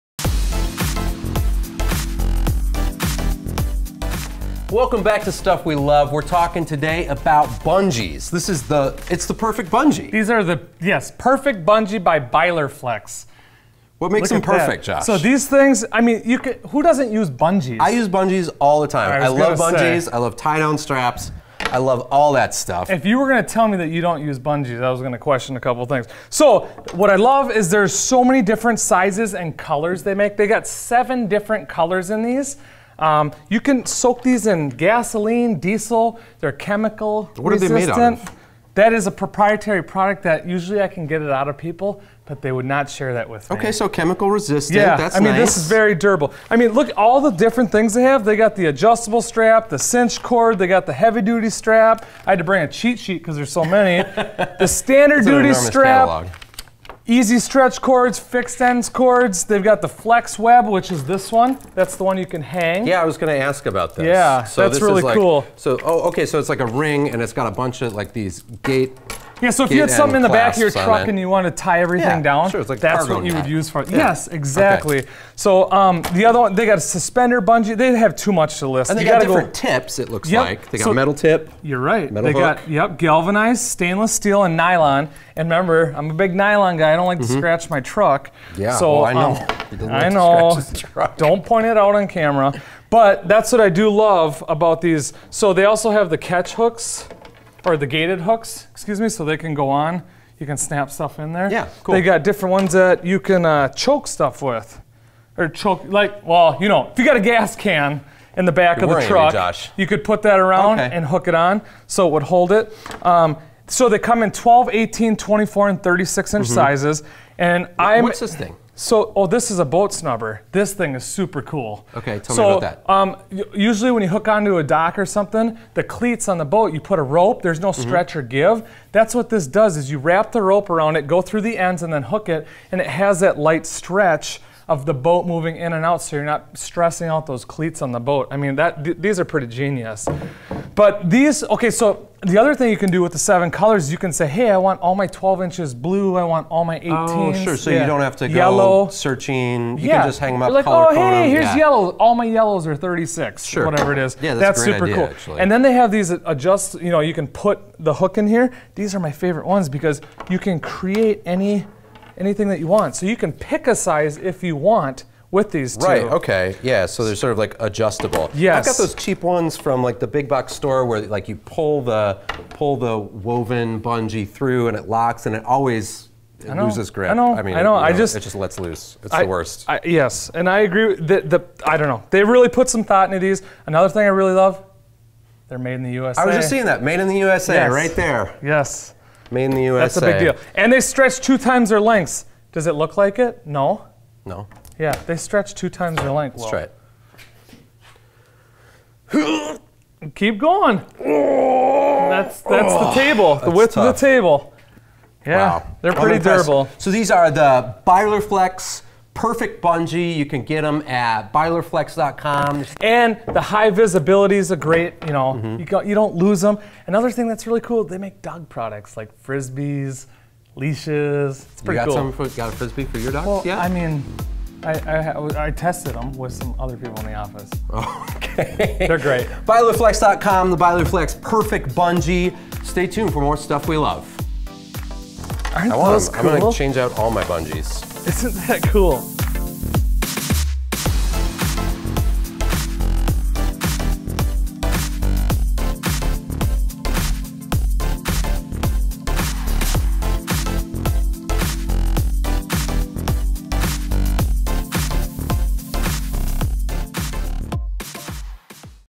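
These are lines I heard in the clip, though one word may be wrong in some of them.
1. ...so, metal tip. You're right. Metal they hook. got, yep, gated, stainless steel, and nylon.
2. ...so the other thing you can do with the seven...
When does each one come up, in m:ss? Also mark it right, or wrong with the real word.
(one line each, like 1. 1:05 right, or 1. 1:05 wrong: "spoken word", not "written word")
1. 1:20 wrong: "galvanized", not "gated"
2. 2:21 right.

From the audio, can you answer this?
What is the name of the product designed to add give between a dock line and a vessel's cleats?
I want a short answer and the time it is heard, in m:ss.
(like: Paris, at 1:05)
boat snubber, at 1:59.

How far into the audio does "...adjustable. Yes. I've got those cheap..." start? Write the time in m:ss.
2:47.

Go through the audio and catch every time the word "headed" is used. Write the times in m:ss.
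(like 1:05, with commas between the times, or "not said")
not said.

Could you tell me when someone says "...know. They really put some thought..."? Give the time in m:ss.
3:01.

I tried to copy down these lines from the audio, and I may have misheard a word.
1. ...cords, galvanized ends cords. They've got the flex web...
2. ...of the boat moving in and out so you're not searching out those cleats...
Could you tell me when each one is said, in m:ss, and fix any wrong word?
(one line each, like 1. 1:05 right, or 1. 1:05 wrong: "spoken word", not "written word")
1. 0:57 wrong: "fixed", not "galvanized"
2. 2:14 wrong: "stressing", not "searching".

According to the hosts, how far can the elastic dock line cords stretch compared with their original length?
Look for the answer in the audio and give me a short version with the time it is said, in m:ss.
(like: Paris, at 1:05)
two times their length, at 3:11.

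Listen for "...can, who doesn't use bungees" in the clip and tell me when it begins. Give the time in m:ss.
0:16.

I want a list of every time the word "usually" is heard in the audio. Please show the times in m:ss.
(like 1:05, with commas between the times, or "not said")
0:40, 2:03.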